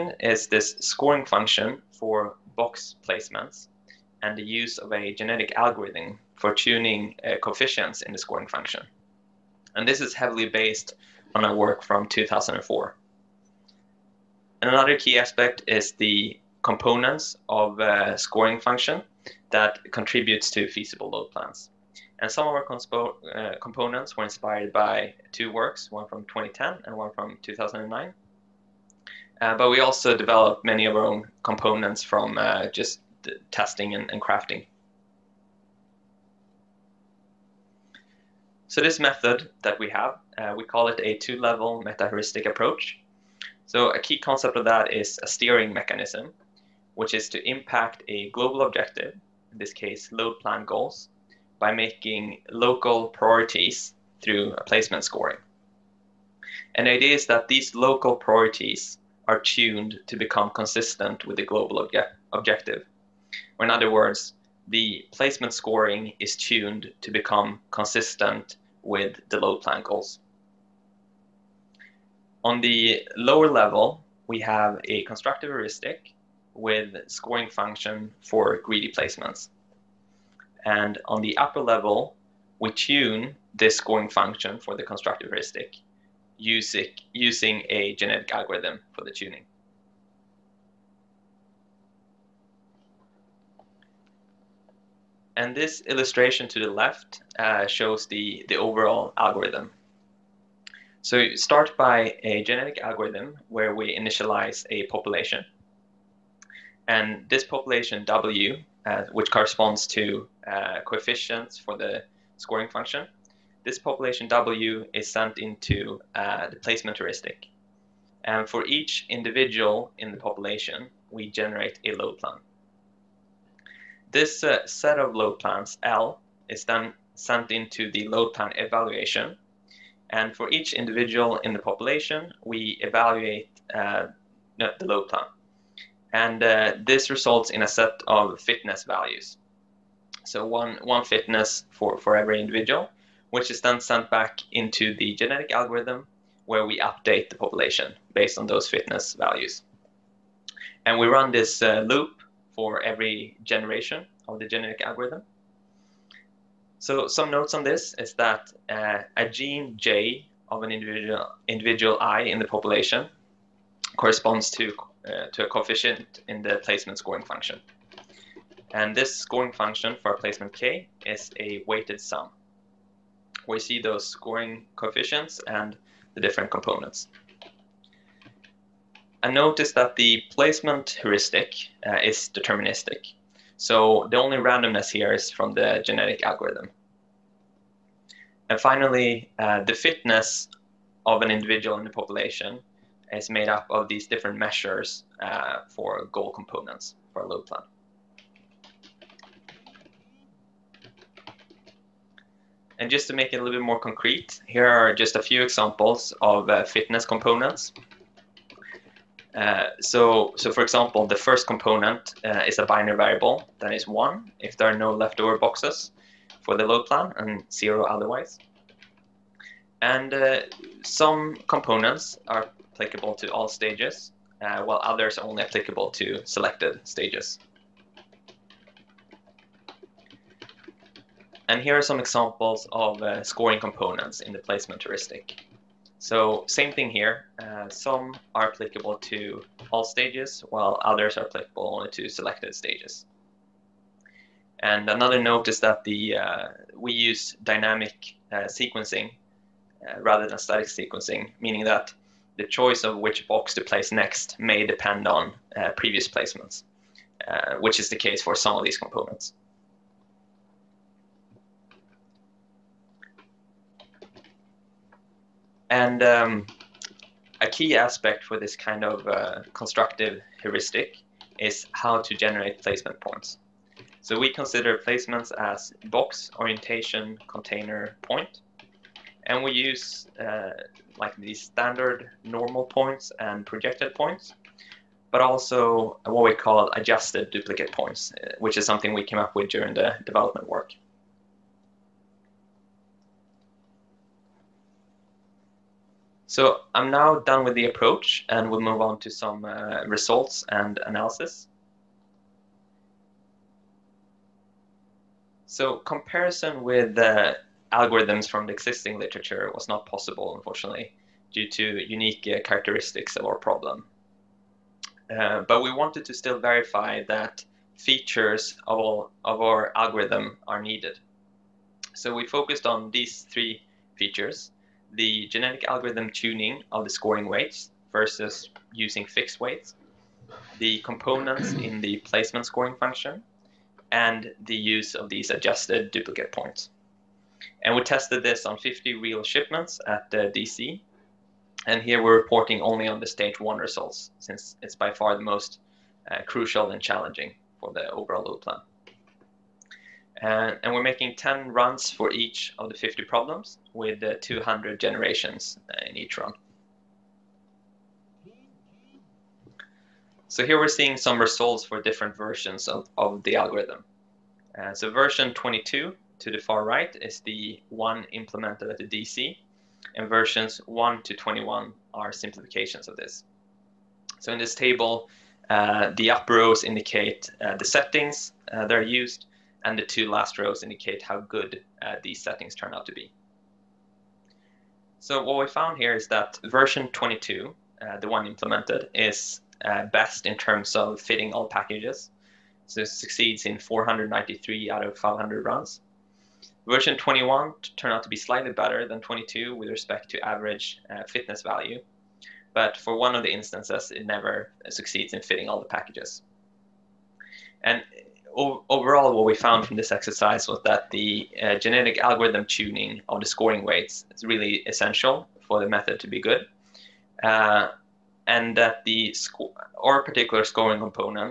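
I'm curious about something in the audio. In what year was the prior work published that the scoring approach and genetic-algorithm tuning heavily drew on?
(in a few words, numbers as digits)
2004.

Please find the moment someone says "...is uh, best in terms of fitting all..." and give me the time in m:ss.
6:28.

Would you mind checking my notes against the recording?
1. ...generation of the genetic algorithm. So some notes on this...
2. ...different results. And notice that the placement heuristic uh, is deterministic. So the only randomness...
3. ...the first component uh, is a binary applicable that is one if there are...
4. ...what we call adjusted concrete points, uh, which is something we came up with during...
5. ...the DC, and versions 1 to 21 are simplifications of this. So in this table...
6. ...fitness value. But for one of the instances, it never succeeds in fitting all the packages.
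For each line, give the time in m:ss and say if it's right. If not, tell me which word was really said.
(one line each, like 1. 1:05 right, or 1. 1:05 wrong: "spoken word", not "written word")
1. 2:33 right
2. 2:56 wrong: "components", not "results"
3. 3:31 wrong: "variable", not "applicable"
4. 4:46 wrong: "duplicate", not "concrete"
5. 6:08 right
6. 6:41 right.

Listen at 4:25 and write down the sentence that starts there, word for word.
And um, a key aspect for this kind of uh, constructive heuristic is how to generate placement points.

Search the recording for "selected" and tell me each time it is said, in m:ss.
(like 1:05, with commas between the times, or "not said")
3:46, 4:02.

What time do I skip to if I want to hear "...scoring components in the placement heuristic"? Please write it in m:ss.
3:53.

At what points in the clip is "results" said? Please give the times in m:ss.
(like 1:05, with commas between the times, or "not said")
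2:17, 4:59, 5:43, 6:01.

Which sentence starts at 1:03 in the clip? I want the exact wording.
Or in other words, the placement scoring is tuned to become consistent with the load plan goals.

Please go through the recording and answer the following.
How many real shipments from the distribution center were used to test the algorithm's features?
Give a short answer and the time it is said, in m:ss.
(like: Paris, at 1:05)
50, at 5:38.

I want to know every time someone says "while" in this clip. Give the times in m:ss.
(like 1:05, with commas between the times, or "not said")
3:44, 4:00.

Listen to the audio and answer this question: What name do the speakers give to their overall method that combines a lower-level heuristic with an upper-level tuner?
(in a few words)
two-level meta-heuristic approach.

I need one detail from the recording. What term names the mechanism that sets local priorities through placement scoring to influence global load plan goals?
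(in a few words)
steering mechanism.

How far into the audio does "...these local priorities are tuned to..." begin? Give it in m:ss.
0:57.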